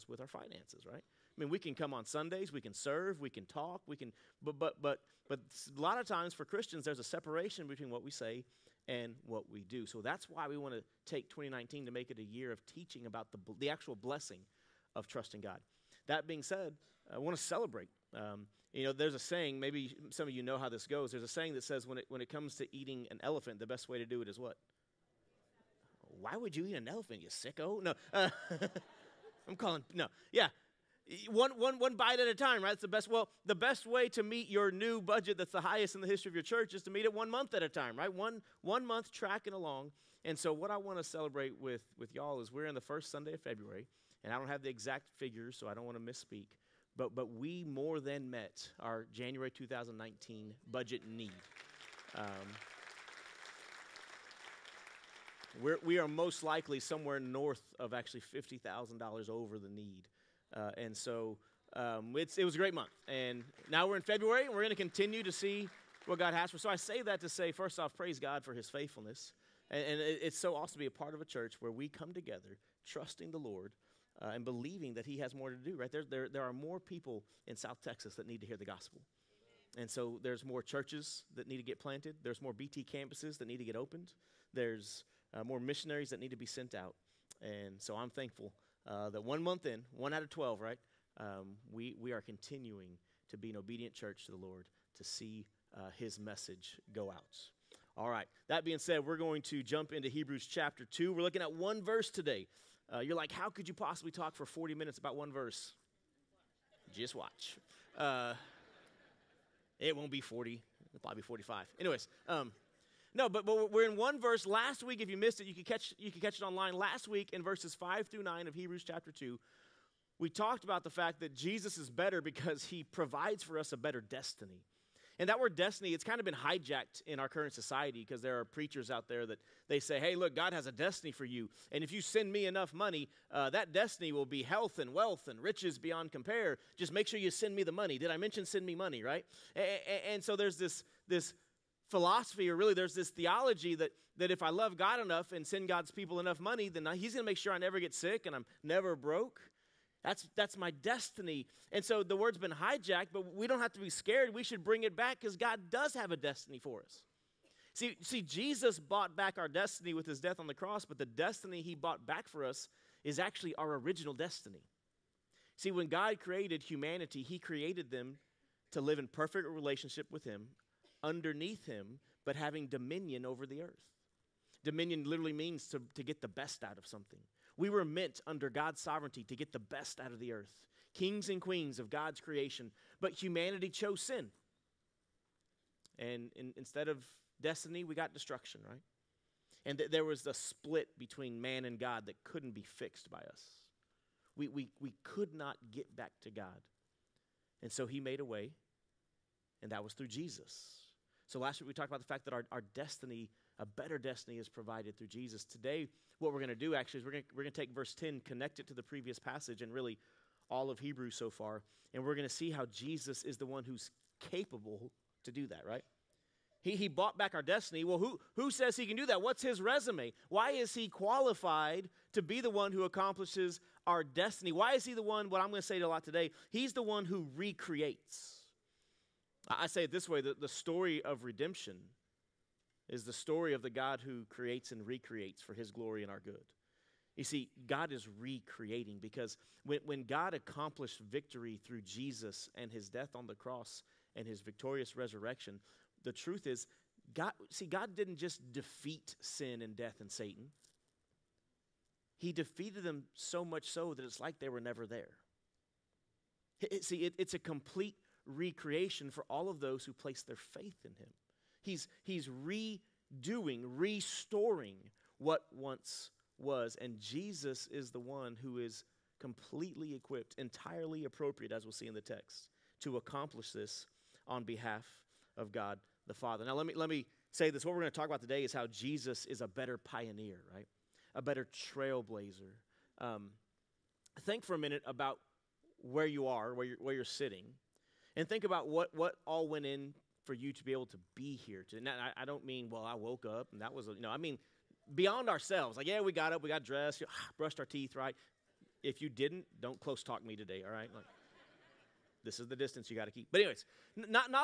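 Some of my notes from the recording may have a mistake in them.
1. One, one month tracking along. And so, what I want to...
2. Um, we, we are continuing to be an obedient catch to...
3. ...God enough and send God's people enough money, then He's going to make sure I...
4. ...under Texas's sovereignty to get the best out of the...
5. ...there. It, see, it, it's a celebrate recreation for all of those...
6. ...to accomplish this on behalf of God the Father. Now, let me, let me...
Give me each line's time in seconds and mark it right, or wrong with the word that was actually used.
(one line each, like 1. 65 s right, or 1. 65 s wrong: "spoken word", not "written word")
1. 38 s right
2. 91 s wrong: "church", not "catch"
3. 144 s right
4. 178 s wrong: "God", not "Texas"
5. 254 s wrong: "complete", not "celebrate"
6. 272 s right.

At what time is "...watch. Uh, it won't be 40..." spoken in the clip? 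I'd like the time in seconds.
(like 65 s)
107 s.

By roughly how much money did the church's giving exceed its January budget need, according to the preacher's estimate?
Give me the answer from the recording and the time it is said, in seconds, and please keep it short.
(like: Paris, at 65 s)
$50,000, at 58 s.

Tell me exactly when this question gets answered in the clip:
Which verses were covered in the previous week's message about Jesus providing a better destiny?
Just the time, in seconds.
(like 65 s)
117 s.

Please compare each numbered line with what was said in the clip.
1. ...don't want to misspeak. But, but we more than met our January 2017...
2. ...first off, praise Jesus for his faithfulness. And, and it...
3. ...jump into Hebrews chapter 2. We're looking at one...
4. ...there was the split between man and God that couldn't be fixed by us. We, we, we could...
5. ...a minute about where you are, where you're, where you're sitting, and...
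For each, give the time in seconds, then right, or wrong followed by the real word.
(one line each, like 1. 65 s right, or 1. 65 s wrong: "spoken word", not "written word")
1. 45 s wrong: "2019", not "2017"
2. 67 s wrong: "God", not "Jesus"
3. 99 s right
4. 189 s right
5. 284 s right.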